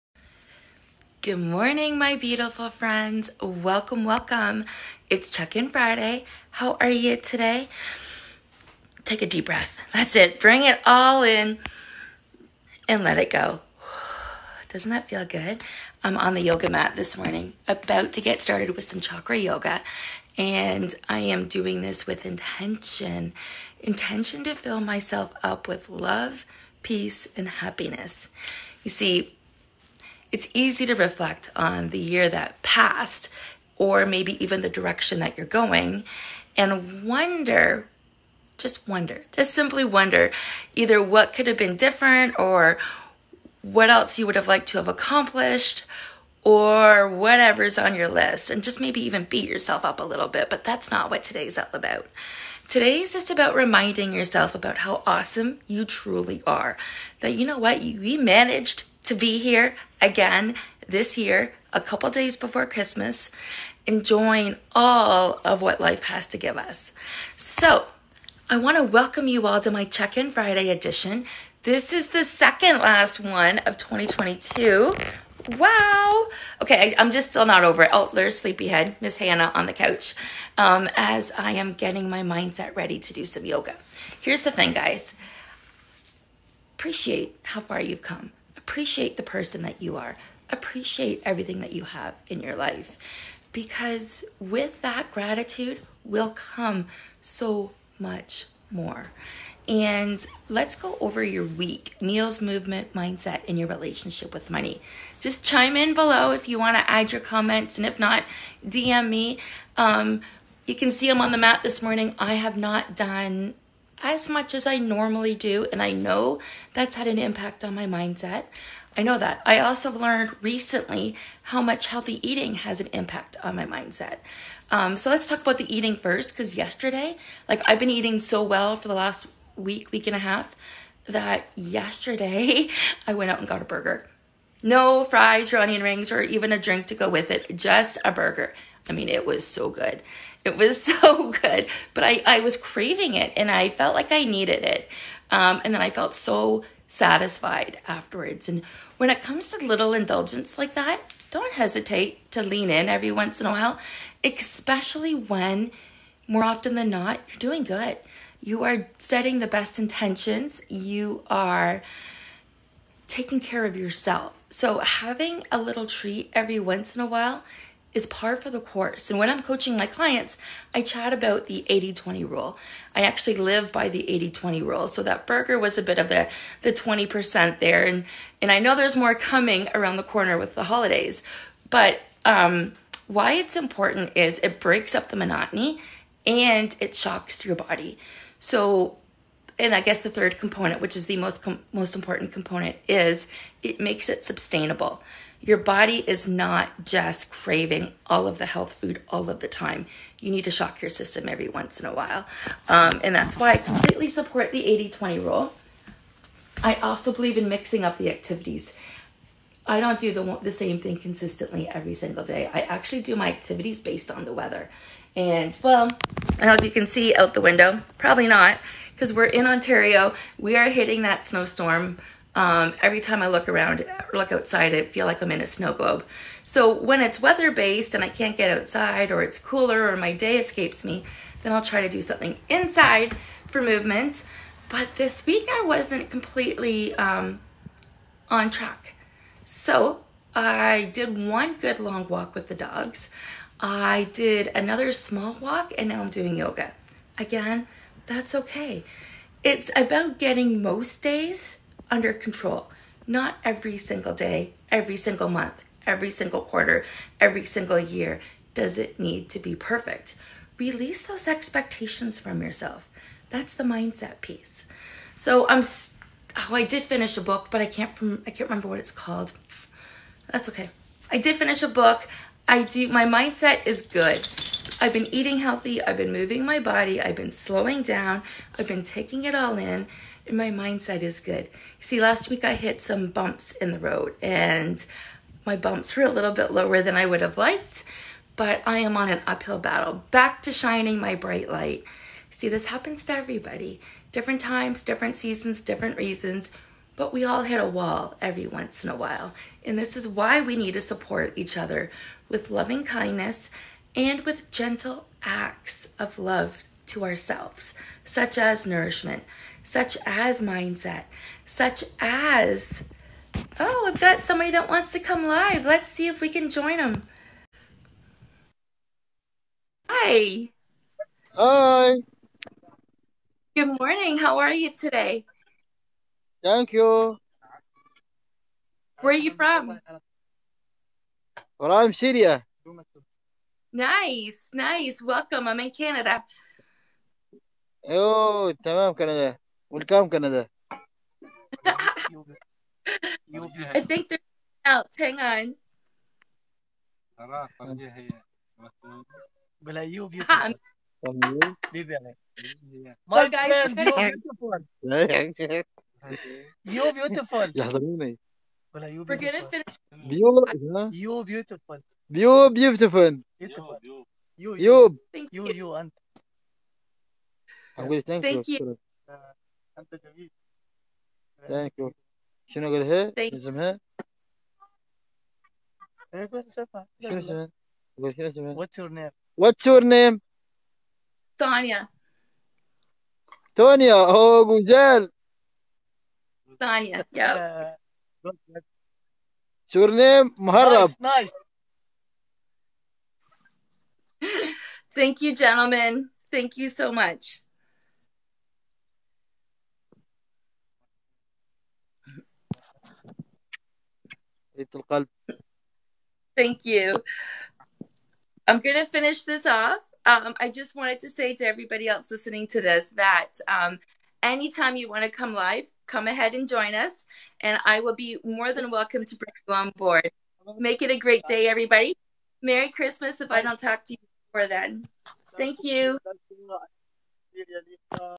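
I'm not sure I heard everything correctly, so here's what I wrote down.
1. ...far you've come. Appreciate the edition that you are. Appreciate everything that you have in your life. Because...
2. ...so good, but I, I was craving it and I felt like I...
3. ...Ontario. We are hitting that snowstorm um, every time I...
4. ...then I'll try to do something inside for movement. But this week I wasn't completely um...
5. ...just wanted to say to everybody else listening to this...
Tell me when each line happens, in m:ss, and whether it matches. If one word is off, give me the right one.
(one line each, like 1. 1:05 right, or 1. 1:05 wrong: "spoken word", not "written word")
1. 1:27 wrong: "person", not "edition"
2. 2:20 right
3. 3:39 right
4. 3:51 right
5. 6:50 right.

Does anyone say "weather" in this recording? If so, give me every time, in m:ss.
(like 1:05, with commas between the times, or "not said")
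3:34, 3:47.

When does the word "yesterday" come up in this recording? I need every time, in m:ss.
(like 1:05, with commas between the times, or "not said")
2:06, 2:11.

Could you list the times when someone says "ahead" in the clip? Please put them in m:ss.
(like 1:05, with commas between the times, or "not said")
6:56.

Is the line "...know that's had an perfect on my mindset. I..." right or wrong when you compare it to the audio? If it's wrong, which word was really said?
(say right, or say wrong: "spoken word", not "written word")
wrong: "impact", not "perfect".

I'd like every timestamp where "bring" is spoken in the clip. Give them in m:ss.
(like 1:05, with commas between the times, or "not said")
0:10, 6:59.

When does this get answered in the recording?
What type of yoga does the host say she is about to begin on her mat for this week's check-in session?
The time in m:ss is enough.
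0:18.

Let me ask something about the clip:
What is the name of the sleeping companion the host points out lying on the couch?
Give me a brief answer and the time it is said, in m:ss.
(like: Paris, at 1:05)
Hannah, at 1:19.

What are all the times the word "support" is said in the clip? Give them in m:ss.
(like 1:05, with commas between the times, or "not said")
3:24, 5:00.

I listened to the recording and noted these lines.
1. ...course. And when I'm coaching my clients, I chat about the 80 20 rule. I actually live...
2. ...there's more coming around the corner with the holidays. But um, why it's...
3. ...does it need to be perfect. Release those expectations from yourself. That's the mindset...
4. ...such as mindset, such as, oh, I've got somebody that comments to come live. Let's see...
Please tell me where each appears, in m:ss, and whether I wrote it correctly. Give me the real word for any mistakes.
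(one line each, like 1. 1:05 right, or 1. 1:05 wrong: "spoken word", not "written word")
1. 2:48 right
2. 2:58 right
3. 4:18 right
4. 5:09 wrong: "wants", not "comments".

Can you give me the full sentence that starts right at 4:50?
Back to shining my bright light.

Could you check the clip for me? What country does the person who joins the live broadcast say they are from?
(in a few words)
Syria.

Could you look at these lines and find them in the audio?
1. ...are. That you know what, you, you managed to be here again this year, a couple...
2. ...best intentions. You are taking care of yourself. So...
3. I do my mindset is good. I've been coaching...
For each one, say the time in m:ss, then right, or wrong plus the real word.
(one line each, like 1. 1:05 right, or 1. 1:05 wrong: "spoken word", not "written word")
1. 0:56 right
2. 2:39 right
3. 4:32 wrong: "eating", not "coaching".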